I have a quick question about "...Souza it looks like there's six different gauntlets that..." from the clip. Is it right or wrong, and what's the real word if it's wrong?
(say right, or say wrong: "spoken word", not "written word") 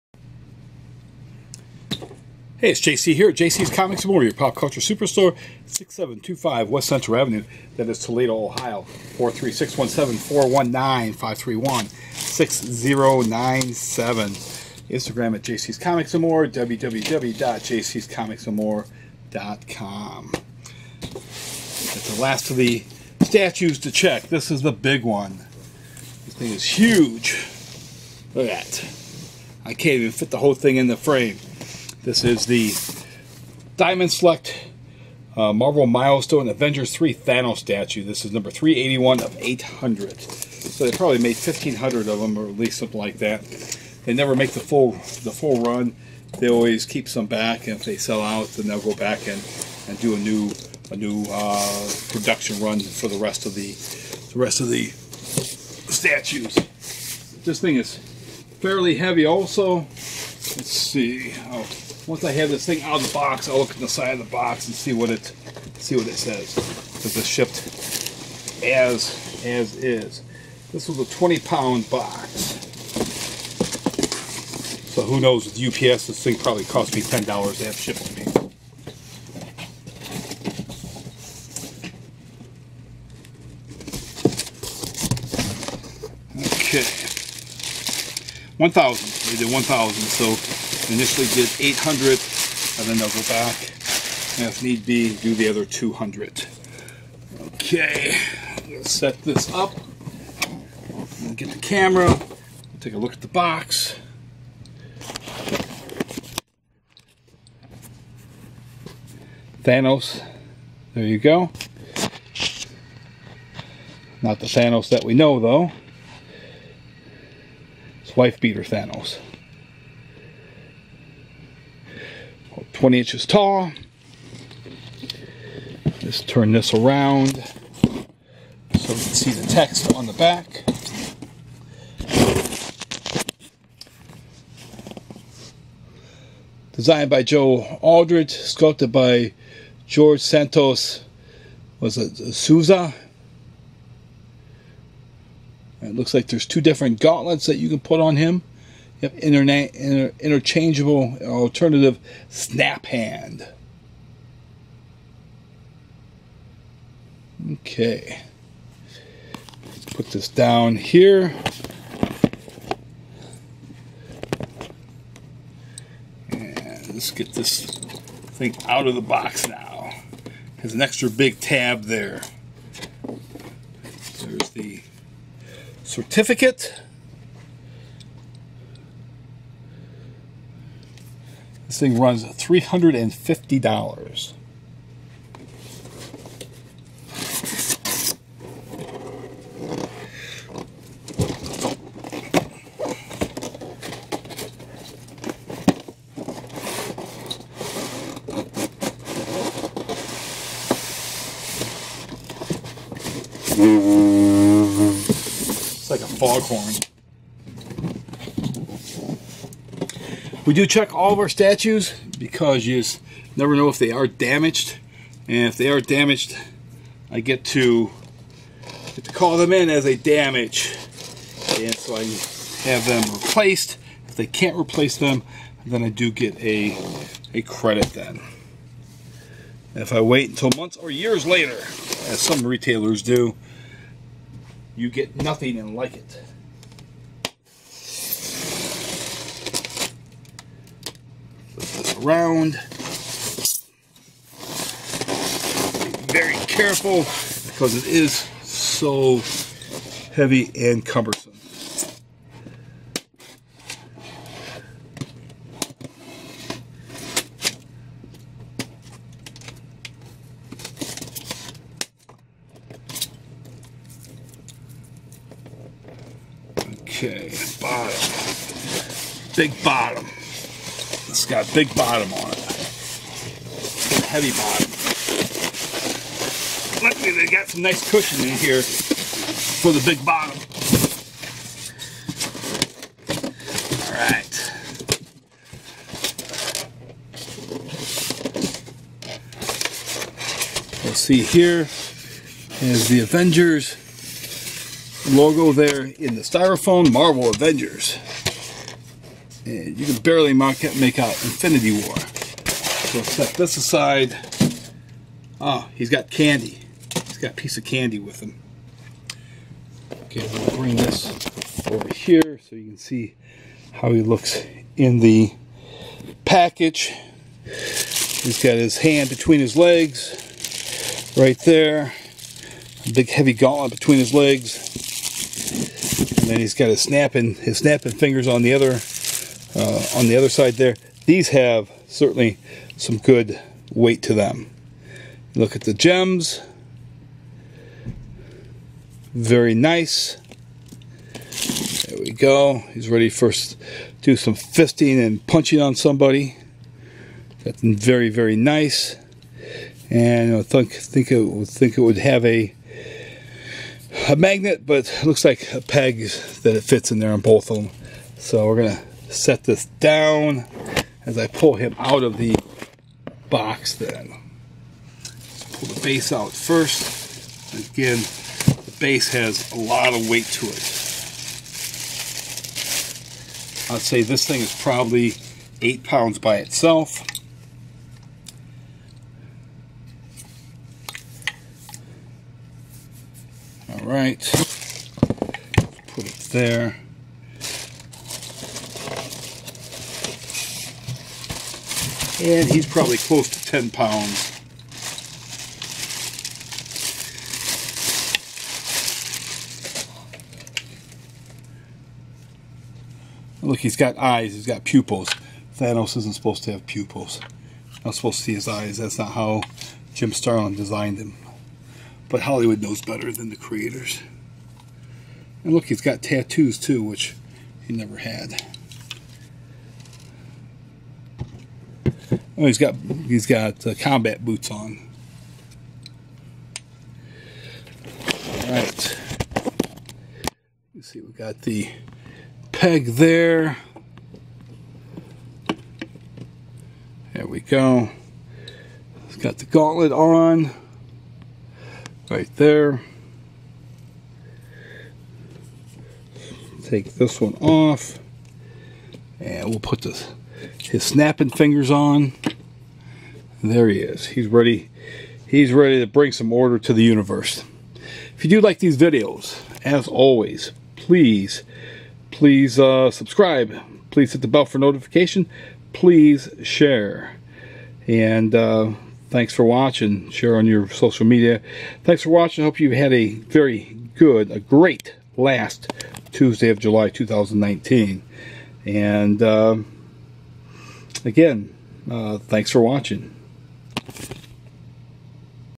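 wrong: "two", not "six".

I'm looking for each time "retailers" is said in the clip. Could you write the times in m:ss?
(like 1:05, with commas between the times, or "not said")
3:52.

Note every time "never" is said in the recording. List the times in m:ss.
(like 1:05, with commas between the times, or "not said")
0:44, 3:33, 6:57.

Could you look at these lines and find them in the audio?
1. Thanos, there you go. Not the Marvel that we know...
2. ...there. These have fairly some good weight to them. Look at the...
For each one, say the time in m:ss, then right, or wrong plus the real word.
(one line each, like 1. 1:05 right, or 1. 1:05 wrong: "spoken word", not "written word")
1. 1:49 wrong: "Thanos", not "Marvel"
2. 5:30 wrong: "certainly", not "fairly".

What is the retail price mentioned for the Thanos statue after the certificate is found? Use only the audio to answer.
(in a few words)
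$350.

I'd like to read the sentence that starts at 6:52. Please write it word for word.
But Hollywood knows better than the creators.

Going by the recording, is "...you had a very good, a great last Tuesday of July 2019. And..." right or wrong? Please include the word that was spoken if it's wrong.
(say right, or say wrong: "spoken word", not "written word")
right.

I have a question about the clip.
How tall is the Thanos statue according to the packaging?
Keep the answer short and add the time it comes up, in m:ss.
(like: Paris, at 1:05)
20 inches, at 2:02.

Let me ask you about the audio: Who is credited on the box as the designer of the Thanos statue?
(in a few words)
Joe Aldridge.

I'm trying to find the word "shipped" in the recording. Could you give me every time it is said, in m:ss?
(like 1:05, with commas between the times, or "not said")
1:07, 1:17.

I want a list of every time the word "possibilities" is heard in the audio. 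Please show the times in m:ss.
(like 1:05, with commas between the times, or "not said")
not said.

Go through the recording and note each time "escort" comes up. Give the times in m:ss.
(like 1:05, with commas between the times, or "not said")
not said.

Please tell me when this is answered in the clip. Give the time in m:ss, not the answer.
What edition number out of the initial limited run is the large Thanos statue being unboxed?
0:38.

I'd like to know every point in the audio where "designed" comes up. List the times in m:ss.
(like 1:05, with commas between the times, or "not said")
2:16, 6:50.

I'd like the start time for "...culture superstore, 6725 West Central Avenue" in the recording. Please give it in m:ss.
0:04.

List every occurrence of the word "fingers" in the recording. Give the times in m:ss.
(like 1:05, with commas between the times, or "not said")
5:27, 7:31.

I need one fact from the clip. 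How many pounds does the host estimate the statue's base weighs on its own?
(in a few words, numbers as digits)
8 pounds.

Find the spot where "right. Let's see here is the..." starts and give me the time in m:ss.
4:49.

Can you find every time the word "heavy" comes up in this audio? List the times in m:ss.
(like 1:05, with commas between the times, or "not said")
0:58, 4:10, 4:34, 5:23.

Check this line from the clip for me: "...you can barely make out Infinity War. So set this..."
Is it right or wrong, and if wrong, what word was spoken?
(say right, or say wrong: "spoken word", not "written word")
right.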